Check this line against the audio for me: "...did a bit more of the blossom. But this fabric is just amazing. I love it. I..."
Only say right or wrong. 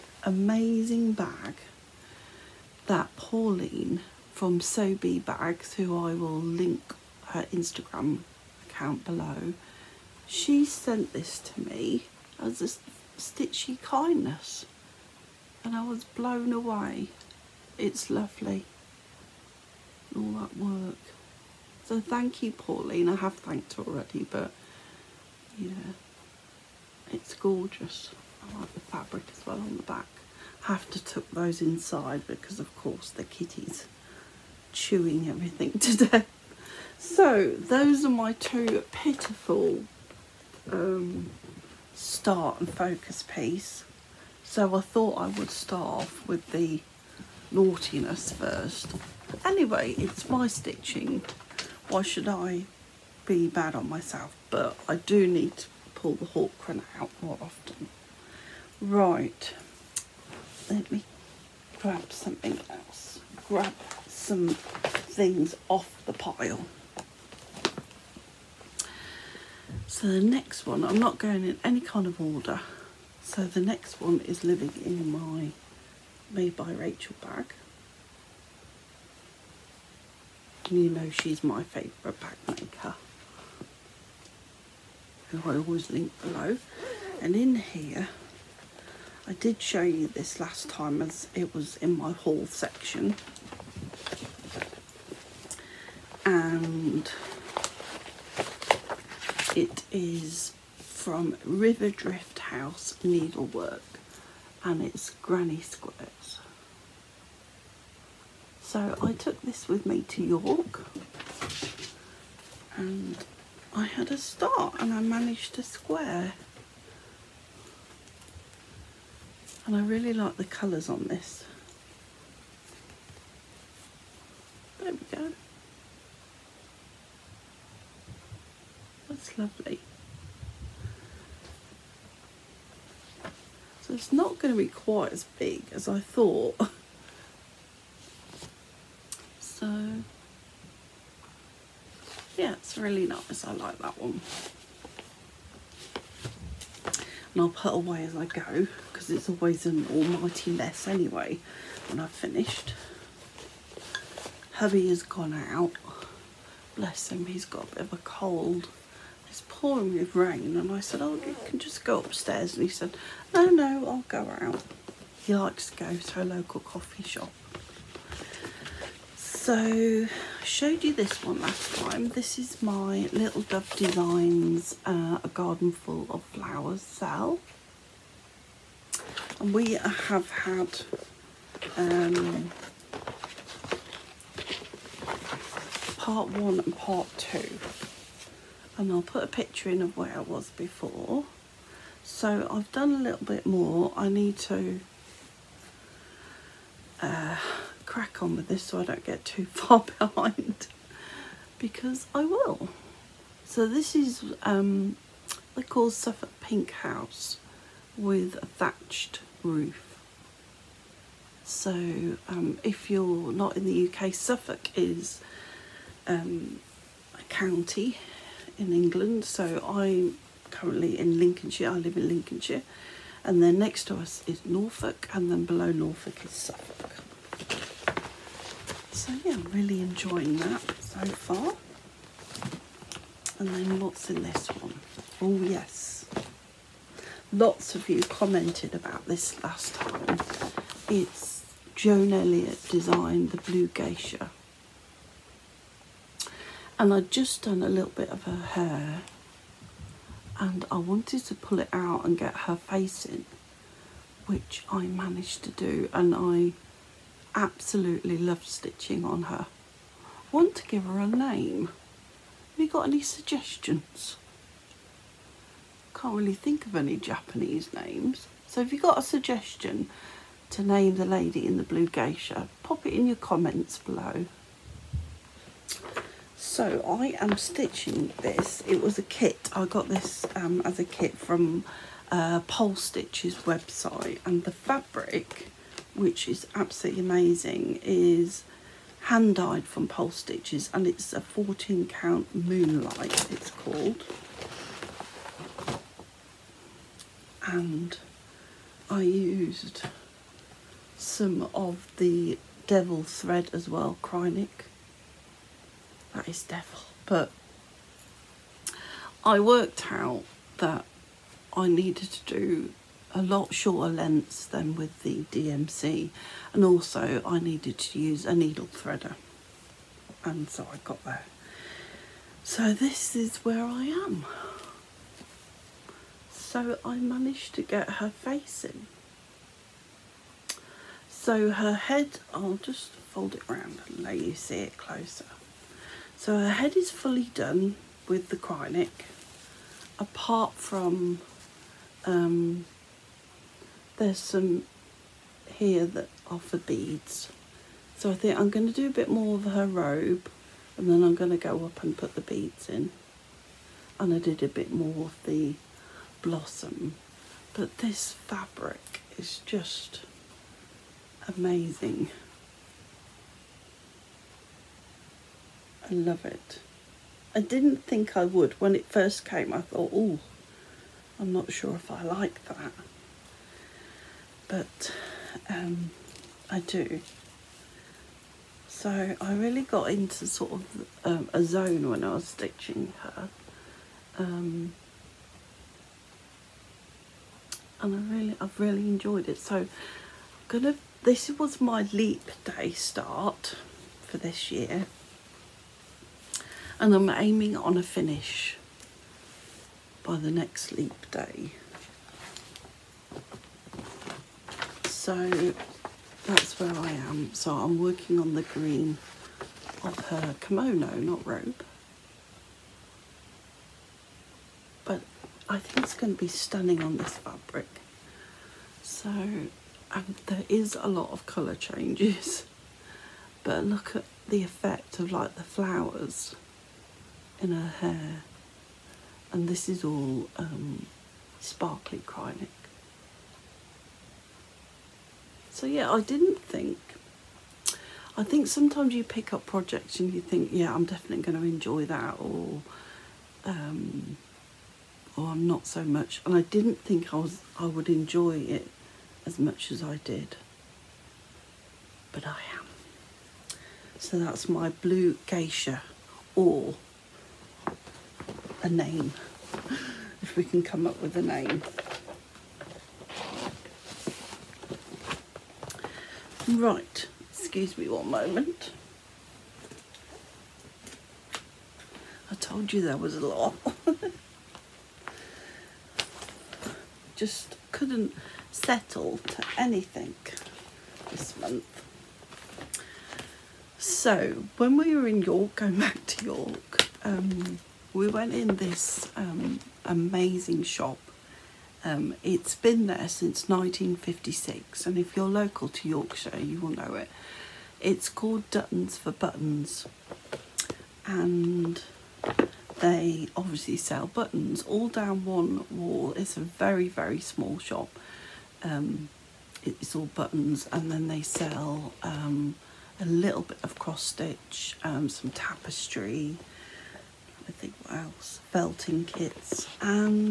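right.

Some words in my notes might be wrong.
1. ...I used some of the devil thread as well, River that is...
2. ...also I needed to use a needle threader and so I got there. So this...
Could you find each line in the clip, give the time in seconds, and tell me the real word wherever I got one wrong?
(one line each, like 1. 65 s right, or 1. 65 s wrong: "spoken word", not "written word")
1. 298 s wrong: "Kreinik", not "River"
2. 316 s right.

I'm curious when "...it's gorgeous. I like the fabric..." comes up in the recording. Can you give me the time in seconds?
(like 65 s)
27 s.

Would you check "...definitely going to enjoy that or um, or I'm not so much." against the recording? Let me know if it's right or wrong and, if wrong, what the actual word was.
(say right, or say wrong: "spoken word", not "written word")
right.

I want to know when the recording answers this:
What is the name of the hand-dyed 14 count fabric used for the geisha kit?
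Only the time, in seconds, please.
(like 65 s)
292 s.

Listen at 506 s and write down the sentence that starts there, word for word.
It's a very, very small shop.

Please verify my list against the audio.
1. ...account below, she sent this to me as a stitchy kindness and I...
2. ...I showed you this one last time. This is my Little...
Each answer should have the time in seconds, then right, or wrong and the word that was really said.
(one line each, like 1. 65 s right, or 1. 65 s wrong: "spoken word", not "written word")
1. 8 s right
2. 170 s right.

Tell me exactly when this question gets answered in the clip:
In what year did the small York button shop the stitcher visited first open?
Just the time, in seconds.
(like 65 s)
493 s.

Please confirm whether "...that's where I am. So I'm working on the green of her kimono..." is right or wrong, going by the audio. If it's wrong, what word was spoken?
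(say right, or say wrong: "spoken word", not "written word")
right.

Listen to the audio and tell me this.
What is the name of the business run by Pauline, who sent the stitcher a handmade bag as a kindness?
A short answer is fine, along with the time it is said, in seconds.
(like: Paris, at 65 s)
Sobe Bags, at 4 s.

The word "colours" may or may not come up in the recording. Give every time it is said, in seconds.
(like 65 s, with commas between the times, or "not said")
120 s, 421 s.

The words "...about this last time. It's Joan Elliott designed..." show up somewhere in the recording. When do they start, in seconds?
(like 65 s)
238 s.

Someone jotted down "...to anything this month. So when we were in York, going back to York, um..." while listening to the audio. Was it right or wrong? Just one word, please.
right.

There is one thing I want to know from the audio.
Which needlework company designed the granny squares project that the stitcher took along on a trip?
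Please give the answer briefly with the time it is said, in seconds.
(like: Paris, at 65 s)
River Drift House Needlework, at 101 s.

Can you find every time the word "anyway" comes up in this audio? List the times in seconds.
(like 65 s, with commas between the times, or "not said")
49 s, 150 s.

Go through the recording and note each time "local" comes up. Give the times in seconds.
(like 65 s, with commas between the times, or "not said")
166 s, 495 s.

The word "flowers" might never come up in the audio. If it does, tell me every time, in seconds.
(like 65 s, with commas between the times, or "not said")
176 s, 425 s.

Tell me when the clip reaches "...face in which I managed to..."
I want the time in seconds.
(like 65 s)
252 s.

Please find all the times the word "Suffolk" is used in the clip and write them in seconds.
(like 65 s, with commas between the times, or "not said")
205 s, 214 s, 226 s.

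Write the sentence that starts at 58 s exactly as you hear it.
Right, let me grab something else.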